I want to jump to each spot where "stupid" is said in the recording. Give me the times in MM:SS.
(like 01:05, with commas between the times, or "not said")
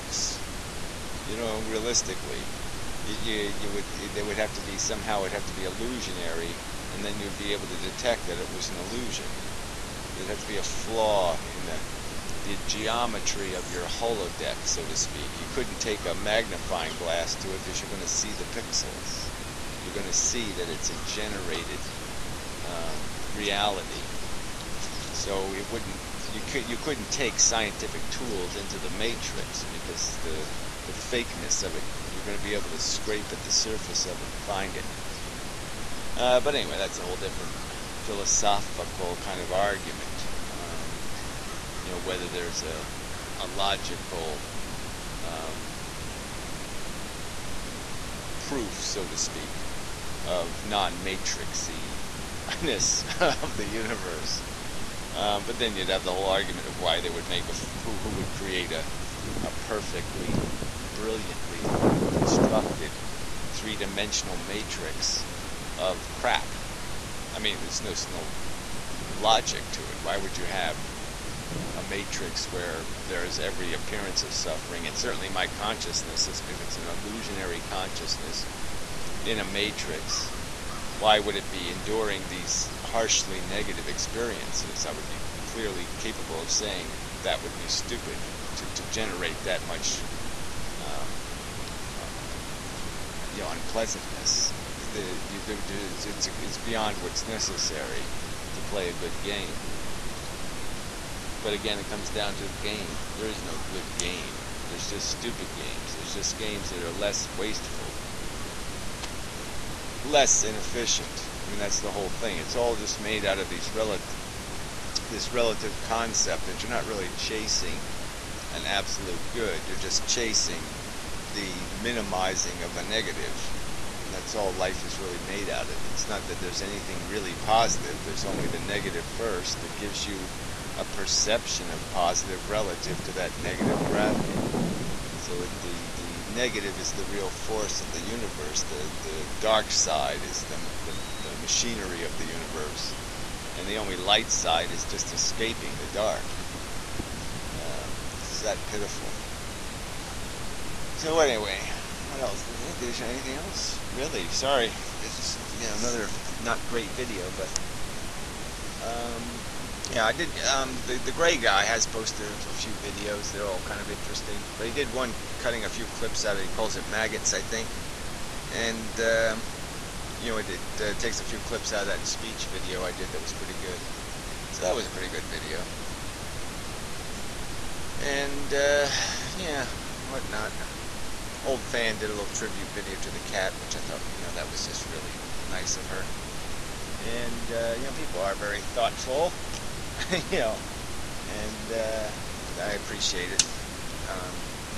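01:27, 01:45.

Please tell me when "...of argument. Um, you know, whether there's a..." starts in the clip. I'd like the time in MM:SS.
00:39.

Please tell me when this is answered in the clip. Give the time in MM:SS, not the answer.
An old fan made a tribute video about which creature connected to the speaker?
03:03.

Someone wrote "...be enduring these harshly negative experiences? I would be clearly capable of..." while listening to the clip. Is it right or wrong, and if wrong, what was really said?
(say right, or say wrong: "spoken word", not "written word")
right.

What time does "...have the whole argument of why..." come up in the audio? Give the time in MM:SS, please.
00:55.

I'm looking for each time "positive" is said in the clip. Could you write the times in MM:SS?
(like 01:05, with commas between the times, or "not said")
02:07, 02:11.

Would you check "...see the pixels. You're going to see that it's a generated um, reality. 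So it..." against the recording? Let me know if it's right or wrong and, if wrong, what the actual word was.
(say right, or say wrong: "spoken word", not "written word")
right.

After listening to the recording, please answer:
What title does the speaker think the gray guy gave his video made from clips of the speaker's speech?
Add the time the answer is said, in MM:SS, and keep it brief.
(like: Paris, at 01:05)
Maggots, at 02:46.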